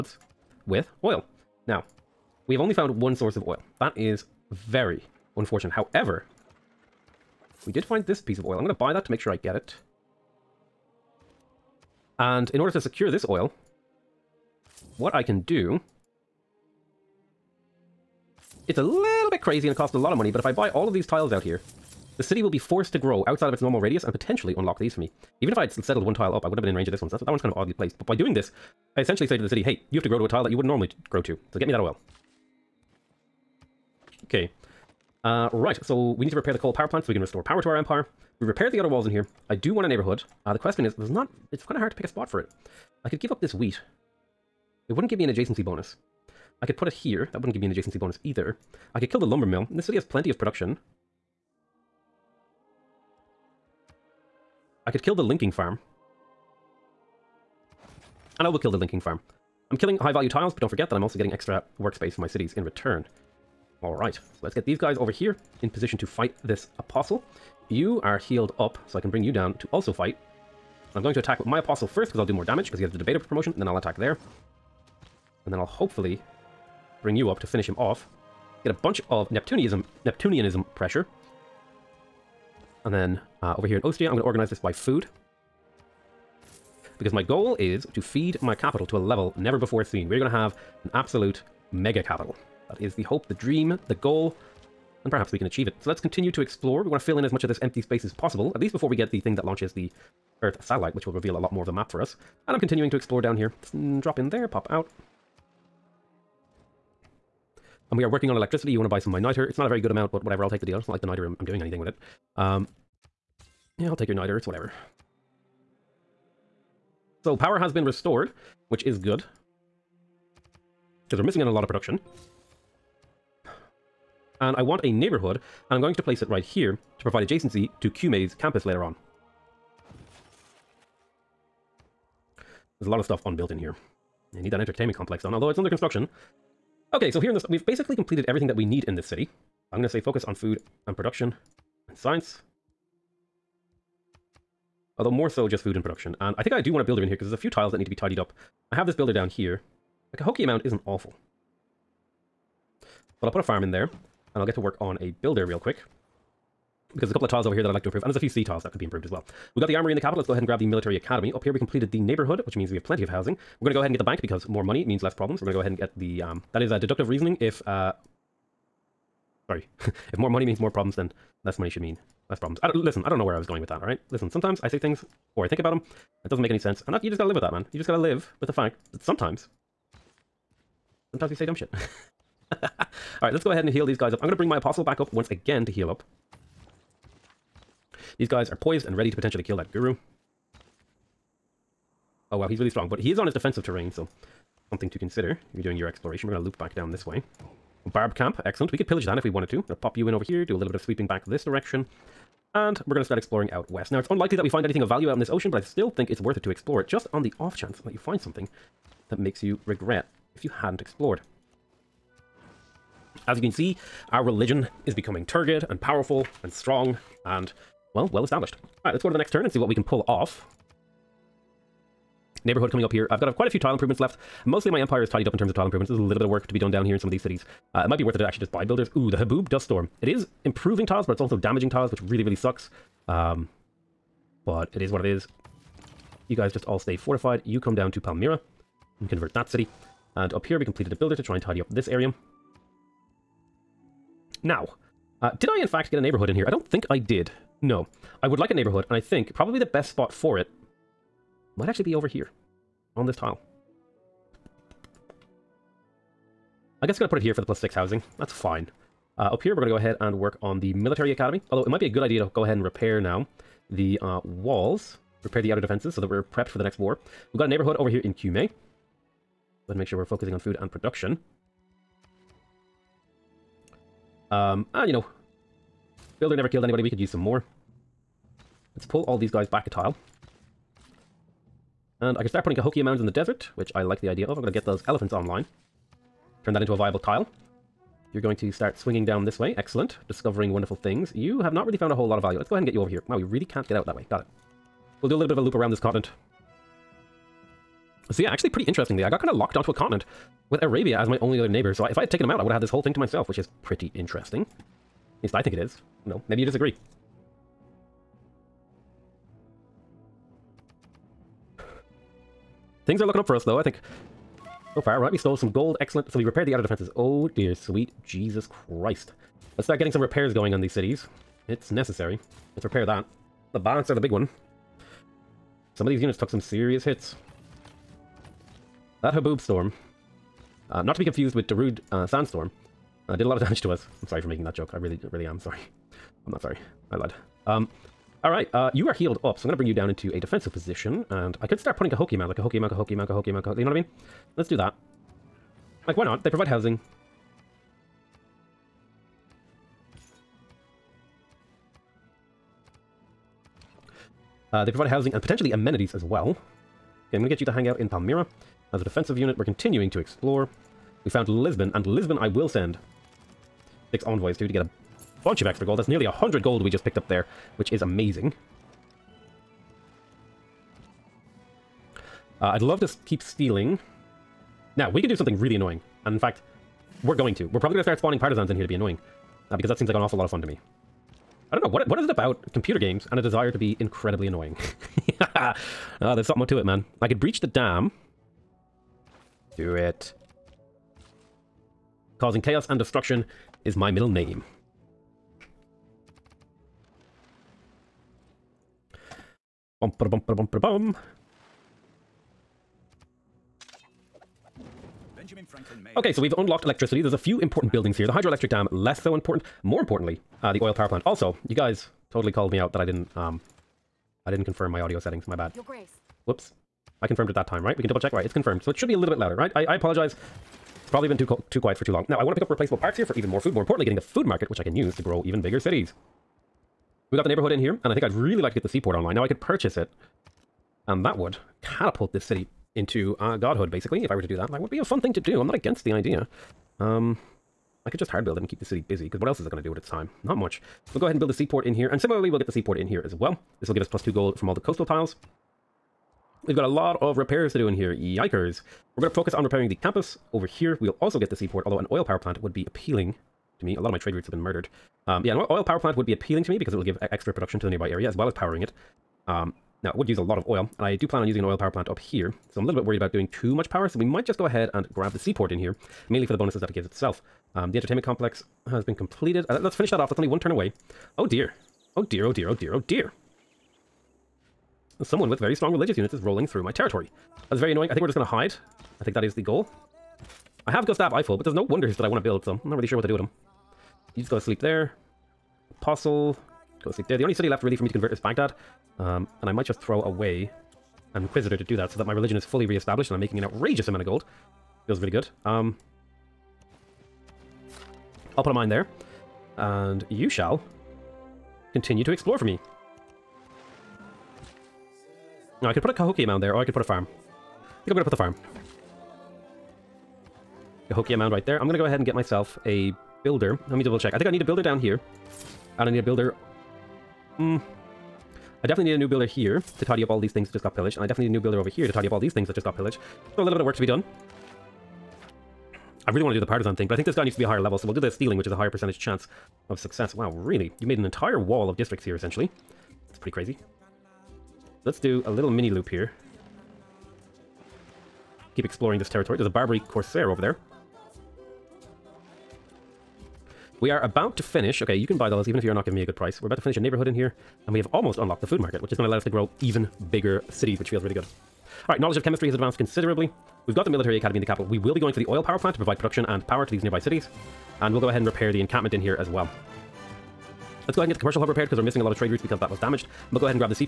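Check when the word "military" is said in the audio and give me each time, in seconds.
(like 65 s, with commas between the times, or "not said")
160 s, 260 s, 553 s.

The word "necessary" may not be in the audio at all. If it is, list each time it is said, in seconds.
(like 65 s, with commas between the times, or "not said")
321 s.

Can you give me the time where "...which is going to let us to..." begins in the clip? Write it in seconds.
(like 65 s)
548 s.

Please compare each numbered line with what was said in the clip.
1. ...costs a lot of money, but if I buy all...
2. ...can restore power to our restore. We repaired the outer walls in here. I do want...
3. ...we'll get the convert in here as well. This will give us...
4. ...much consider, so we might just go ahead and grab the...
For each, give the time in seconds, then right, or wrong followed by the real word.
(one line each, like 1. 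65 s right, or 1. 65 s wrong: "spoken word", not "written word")
1. 19 s right
2. 37 s wrong: "empire", not "restore"
3. 442 s wrong: "seaport", not "convert"
4. 463 s wrong: "power", not "consider".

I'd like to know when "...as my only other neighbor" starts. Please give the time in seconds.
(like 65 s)
300 s.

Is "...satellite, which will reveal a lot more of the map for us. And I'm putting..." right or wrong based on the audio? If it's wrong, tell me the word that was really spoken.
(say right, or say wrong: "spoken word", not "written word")
wrong: "continuing", not "putting".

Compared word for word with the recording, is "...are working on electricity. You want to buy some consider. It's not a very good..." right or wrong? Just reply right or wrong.
wrong.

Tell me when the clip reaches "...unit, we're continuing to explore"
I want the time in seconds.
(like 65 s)
359 s.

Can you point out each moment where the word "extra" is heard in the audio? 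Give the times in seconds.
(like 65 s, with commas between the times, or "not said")
61 s, 365 s, 457 s.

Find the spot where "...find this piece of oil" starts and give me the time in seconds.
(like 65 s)
7 s.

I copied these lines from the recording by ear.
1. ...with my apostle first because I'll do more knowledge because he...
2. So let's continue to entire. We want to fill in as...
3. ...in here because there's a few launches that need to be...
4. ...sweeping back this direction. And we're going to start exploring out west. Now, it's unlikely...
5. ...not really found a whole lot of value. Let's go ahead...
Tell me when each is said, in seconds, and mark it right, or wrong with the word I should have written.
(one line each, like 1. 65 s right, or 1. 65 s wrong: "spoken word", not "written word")
1. 71 s wrong: "damage", not "knowledge"
2. 95 s wrong: "explore", not "entire"
3. 147 s wrong: "tiles", not "launches"
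4. 200 s right
5. 291 s right.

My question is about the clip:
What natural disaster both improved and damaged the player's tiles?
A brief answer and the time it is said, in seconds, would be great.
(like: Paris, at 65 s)
Haboob Dust Storm, at 229 s.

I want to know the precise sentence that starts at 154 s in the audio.
And I'll get to work on a builder real quick.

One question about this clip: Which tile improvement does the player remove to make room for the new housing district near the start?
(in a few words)
Lumber mill.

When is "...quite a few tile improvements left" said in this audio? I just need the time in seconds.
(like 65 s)
223 s.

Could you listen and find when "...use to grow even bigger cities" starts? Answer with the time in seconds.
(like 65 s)
424 s.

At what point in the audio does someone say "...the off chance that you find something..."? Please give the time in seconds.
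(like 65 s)
207 s.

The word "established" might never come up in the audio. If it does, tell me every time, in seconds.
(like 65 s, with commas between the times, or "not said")
218 s, 492 s.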